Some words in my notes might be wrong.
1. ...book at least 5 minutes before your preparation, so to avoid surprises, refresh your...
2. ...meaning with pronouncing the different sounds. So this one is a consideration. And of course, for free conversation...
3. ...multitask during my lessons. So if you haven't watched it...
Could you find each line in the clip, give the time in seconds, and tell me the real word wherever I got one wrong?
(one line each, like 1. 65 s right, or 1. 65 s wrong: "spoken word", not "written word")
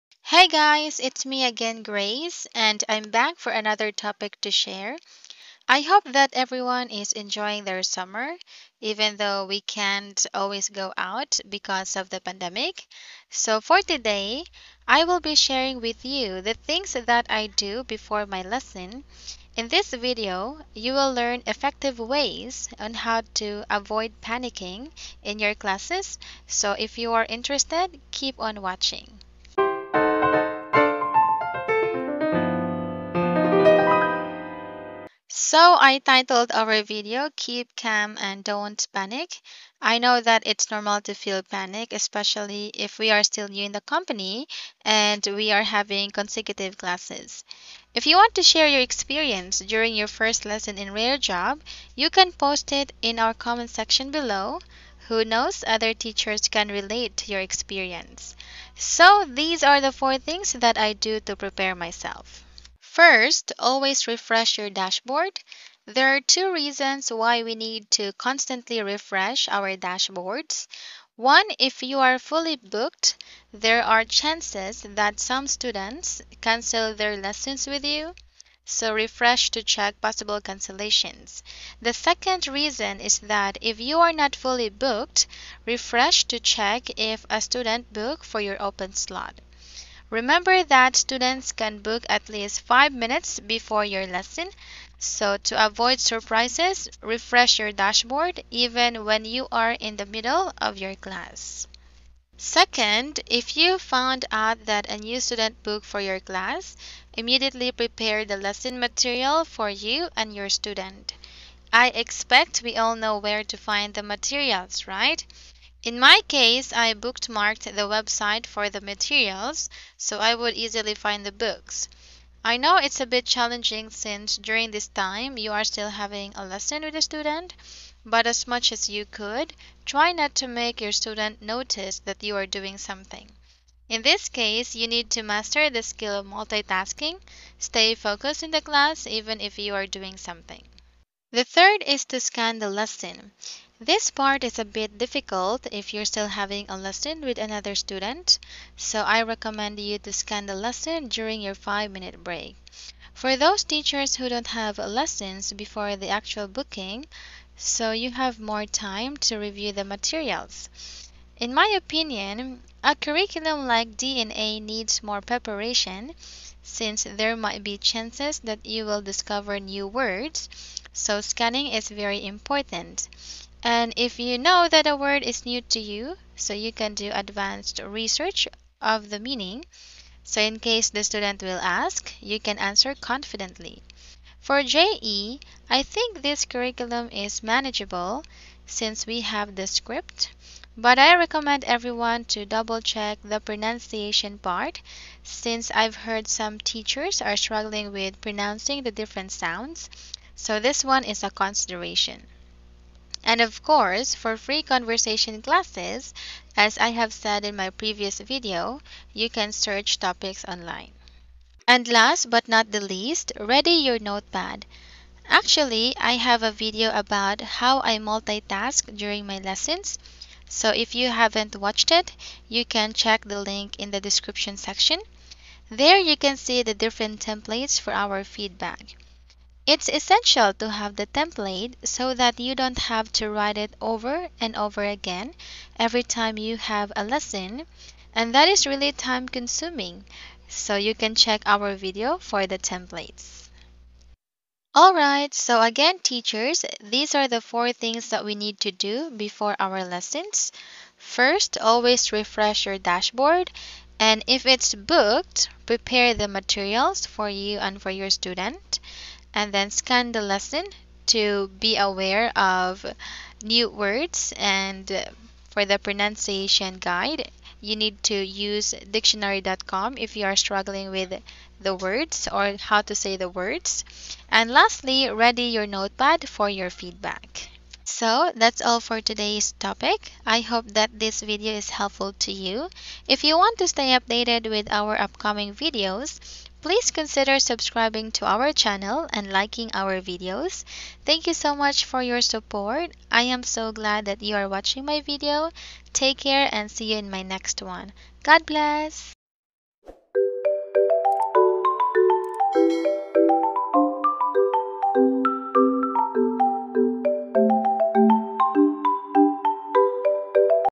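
1. 91 s wrong: "lesson", not "preparation"
2. 197 s wrong: "struggling", not "meaning"
3. 217 s right.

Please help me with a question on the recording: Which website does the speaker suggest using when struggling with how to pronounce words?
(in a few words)
dictionary.com.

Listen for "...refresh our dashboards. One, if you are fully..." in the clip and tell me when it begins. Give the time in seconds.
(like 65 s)
68 s.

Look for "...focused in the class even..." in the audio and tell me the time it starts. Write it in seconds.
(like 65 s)
137 s.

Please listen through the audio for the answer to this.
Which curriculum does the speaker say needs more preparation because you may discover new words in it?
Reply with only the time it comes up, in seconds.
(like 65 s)
163 s.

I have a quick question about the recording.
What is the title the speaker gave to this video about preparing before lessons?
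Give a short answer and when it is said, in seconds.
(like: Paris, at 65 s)
Keep Calm and Don't Panic, at 37 s.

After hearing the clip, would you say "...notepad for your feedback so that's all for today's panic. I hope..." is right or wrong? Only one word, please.
wrong.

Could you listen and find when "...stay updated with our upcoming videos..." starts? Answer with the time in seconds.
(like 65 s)
283 s.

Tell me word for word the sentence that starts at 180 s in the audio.
So in case the student will ask, you can answer confidently.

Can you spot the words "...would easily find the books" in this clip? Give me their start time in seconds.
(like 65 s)
120 s.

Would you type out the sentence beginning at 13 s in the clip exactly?
So, for today, I will be sharing with you the things that I do before my lesson.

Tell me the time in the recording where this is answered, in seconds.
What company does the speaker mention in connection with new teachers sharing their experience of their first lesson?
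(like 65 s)
50 s.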